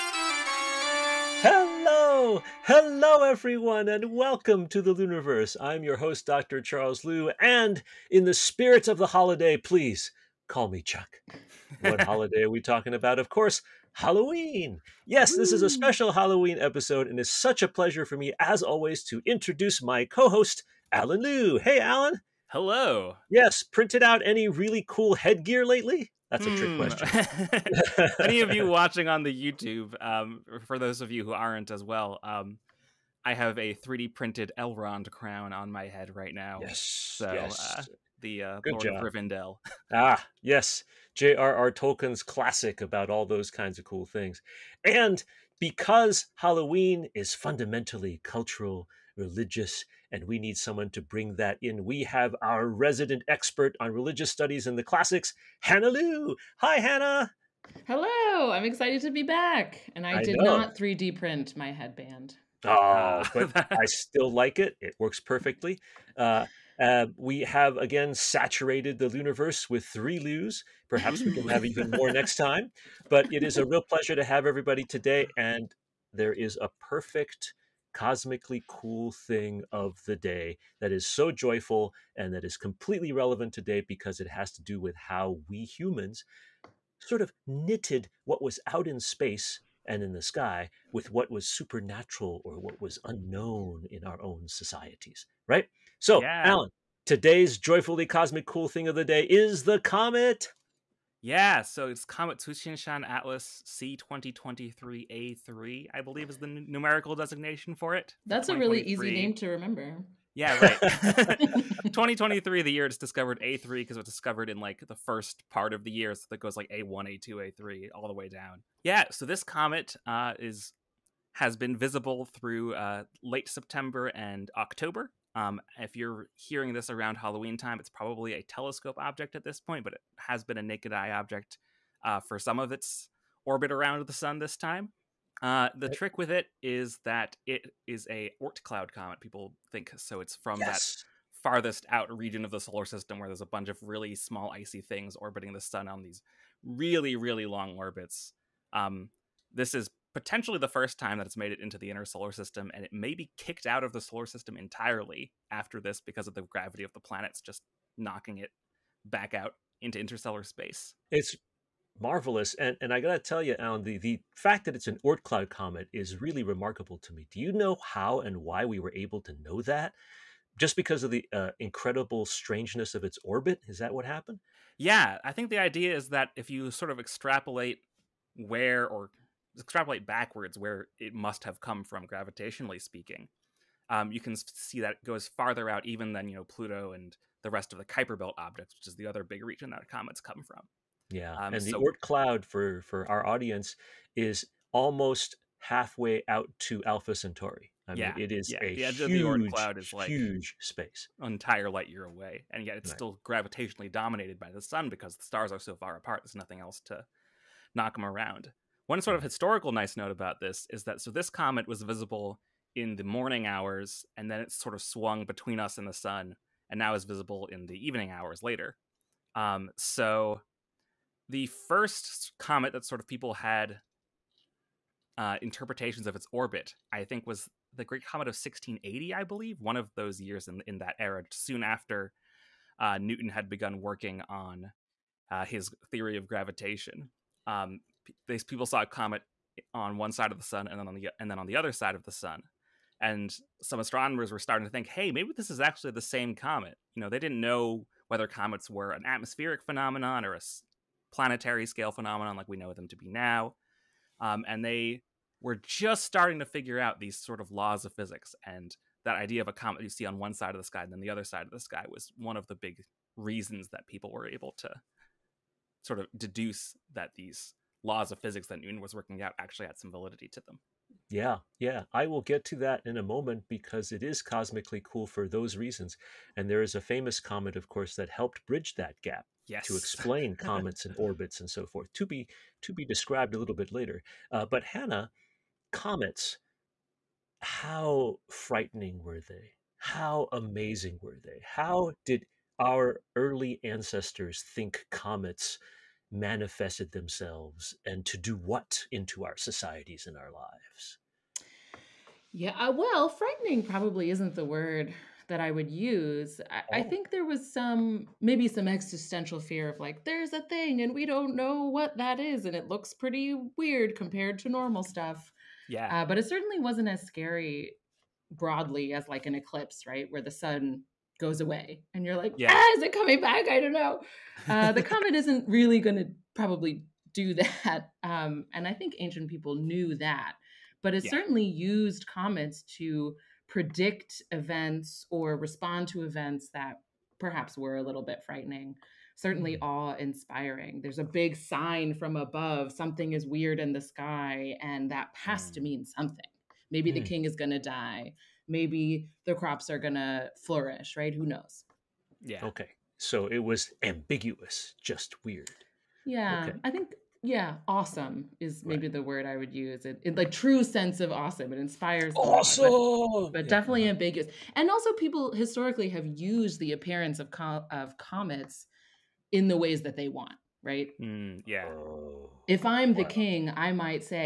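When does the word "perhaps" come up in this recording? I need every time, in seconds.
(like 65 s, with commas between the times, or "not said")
70 s, 337 s.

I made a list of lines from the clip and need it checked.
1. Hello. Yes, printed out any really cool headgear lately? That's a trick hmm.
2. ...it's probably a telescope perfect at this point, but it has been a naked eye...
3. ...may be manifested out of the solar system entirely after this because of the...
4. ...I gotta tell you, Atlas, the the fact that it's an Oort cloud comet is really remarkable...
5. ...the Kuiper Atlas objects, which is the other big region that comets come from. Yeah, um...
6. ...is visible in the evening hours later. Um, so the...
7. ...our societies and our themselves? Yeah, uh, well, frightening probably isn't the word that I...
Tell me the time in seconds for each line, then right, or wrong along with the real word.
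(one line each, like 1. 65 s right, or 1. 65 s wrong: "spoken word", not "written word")
1. 22 s right
2. 127 s wrong: "object", not "perfect"
3. 152 s wrong: "kicked", not "manifested"
4. 162 s wrong: "Allen", not "Atlas"
5. 187 s wrong: "Belt", not "Atlas"
6. 216 s right
7. 299 s wrong: "lives", not "themselves".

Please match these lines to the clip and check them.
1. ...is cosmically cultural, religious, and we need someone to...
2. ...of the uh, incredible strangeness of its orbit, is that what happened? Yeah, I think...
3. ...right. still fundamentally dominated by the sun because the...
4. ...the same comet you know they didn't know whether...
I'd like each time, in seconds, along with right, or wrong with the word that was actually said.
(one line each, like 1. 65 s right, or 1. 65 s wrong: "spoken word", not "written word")
1. 47 s wrong: "fundamentally", not "cosmically"
2. 171 s right
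3. 202 s wrong: "gravitationally", not "fundamentally"
4. 245 s right.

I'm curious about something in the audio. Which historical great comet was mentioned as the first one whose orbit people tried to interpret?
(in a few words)
Great Comet of 1680.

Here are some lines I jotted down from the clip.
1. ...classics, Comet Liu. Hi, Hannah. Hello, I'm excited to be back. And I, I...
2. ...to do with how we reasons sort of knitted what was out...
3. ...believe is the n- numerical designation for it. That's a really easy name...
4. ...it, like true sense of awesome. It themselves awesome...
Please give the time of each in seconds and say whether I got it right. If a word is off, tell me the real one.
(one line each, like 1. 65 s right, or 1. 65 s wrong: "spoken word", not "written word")
1. 54 s wrong: "Hannah", not "Comet"
2. 84 s wrong: "humans", not "reasons"
3. 106 s right
4. 360 s wrong: "inspires", not "themselves".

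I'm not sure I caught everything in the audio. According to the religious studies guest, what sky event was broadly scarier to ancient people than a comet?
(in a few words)
An eclipse.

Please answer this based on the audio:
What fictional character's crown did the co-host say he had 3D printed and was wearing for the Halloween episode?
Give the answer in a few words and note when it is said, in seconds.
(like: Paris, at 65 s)
Elrond, at 34 s.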